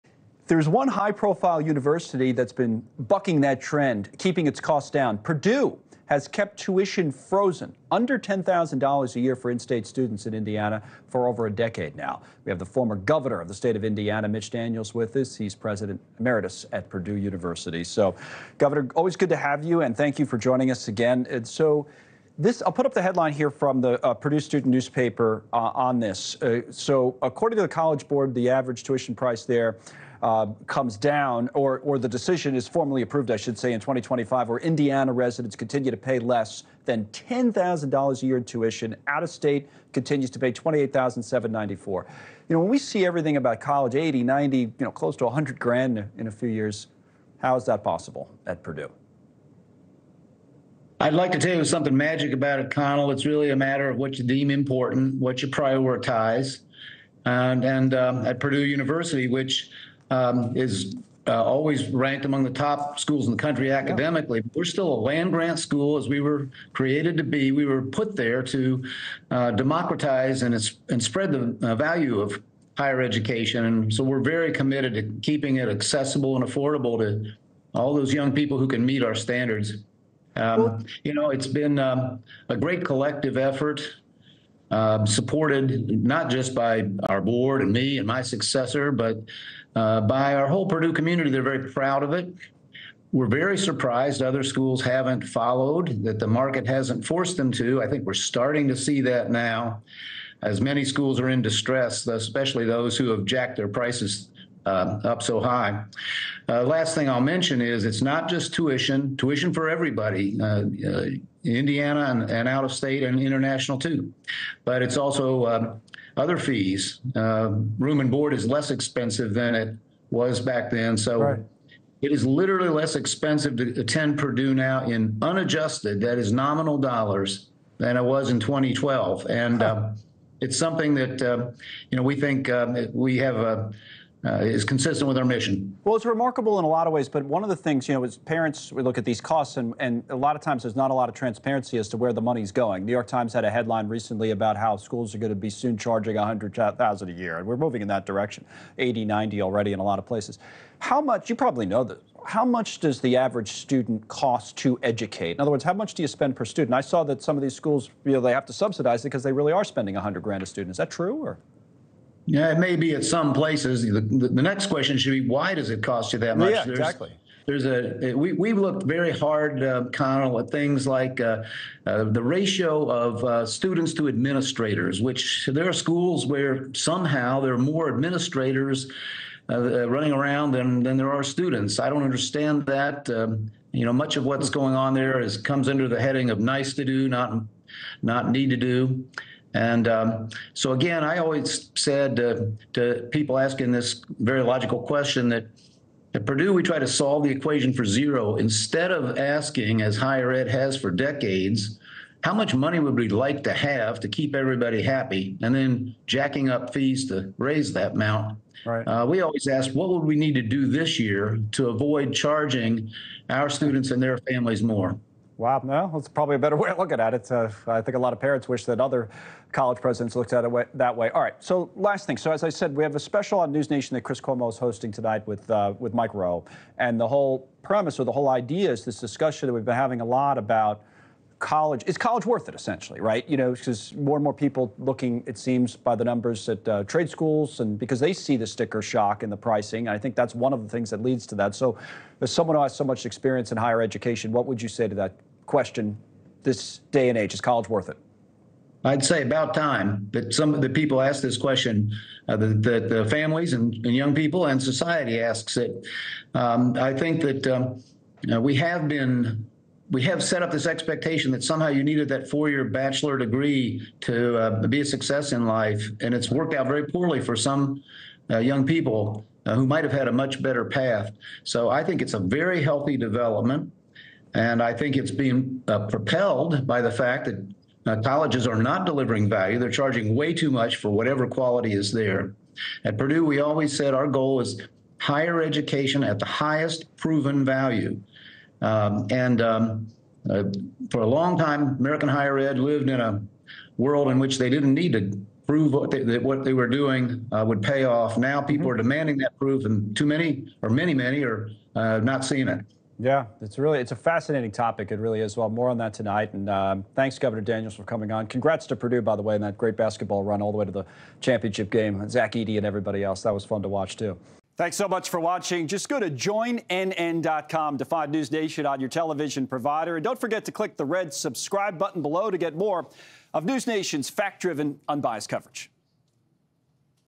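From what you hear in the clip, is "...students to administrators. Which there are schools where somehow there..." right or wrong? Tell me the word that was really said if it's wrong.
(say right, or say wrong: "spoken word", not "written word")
right.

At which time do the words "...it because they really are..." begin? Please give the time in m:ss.
2:39.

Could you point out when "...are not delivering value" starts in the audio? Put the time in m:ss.
4:38.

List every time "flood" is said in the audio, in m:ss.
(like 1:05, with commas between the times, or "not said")
not said.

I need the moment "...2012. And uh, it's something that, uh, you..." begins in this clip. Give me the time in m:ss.
2:08.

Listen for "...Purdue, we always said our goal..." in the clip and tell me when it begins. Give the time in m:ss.
4:42.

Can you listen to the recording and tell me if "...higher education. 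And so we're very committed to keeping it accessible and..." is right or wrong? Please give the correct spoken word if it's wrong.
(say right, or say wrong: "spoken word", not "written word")
right.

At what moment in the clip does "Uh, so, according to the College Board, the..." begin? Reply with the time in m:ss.
0:26.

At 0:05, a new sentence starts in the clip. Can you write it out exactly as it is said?
Purdue has kept tuition frozen under $10,000 a year for in state students in Indiana for over a decade now.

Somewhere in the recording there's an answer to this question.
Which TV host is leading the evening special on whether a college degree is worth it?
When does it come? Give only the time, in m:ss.
3:44.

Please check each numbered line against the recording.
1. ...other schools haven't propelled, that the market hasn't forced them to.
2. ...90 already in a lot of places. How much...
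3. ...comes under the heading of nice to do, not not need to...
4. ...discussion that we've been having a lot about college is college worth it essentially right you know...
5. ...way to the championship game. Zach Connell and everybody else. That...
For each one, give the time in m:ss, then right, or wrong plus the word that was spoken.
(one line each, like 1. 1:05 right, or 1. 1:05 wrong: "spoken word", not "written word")
1. 1:34 wrong: "followed", not "propelled"
2. 2:29 right
3. 3:05 right
4. 3:48 right
5. 5:10 wrong: "Edey", not "Connell".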